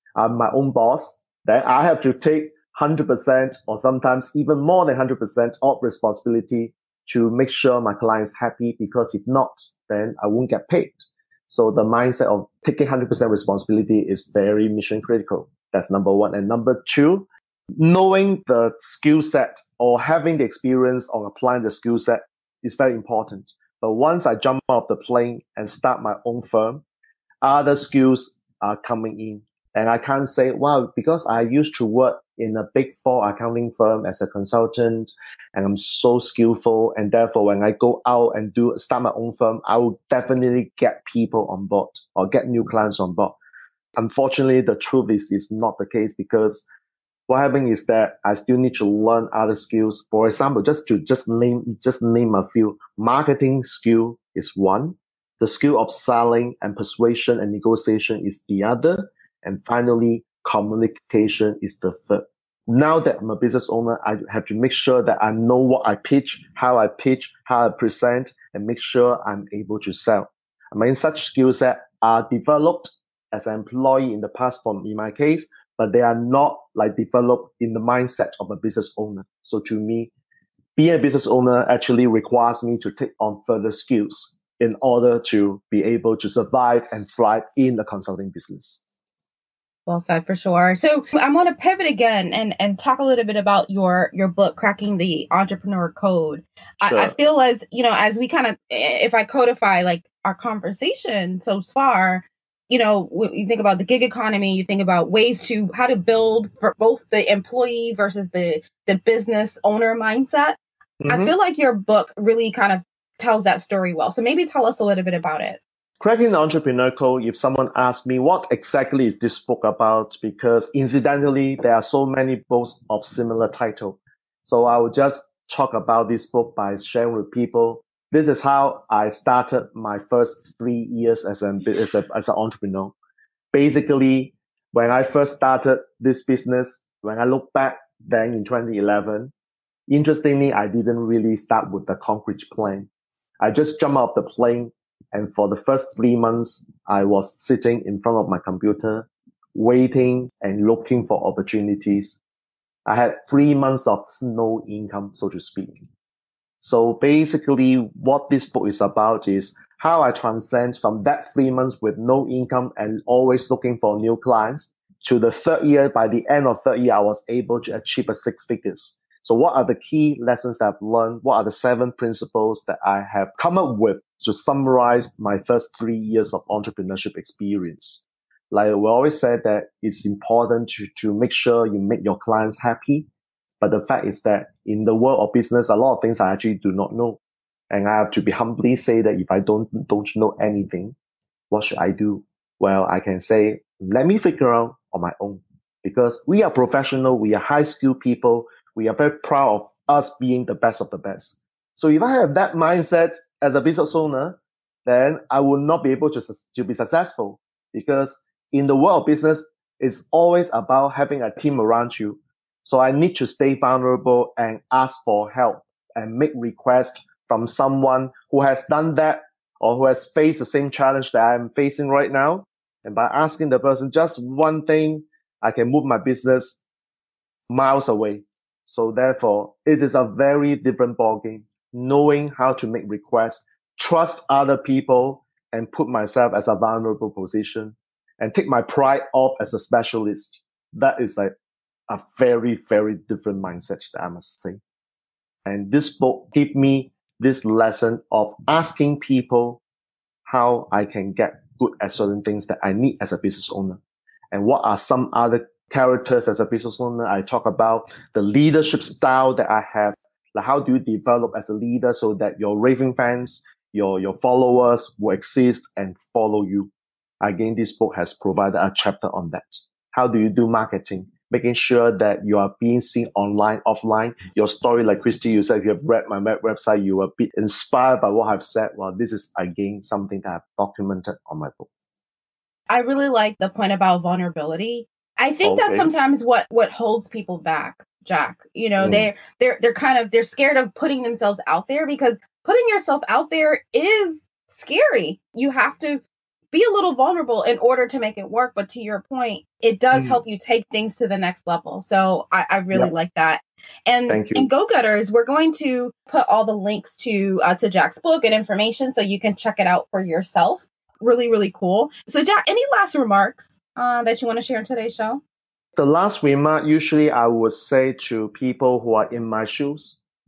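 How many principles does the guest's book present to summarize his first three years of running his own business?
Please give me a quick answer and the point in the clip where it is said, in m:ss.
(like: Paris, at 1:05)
7, at 2:51.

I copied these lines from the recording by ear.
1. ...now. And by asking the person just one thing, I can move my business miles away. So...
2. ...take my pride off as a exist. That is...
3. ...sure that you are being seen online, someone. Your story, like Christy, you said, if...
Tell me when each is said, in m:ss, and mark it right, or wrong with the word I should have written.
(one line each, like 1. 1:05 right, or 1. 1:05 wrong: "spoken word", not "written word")
1. 3:42 right
2. 3:58 wrong: "specialist", not "exist"
3. 4:31 wrong: "offline", not "someone".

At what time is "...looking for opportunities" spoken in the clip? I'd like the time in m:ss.
2:30.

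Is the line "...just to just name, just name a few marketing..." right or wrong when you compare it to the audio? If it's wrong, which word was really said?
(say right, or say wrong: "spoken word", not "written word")
right.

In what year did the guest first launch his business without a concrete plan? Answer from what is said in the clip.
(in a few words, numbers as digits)
2011.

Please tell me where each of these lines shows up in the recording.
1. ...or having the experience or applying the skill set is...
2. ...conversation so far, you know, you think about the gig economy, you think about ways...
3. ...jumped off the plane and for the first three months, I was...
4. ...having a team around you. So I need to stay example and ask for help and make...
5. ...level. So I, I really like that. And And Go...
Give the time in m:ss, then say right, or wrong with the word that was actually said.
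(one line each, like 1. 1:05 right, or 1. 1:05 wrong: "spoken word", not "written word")
1. 0:19 right
2. 1:40 right
3. 2:23 right
4. 3:30 wrong: "vulnerable", not "example"
5. 5:01 right.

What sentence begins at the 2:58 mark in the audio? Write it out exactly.
Like we always said that it's important to, to make sure you make your clients happy.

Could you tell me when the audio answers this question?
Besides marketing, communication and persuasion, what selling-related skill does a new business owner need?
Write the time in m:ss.
0:57.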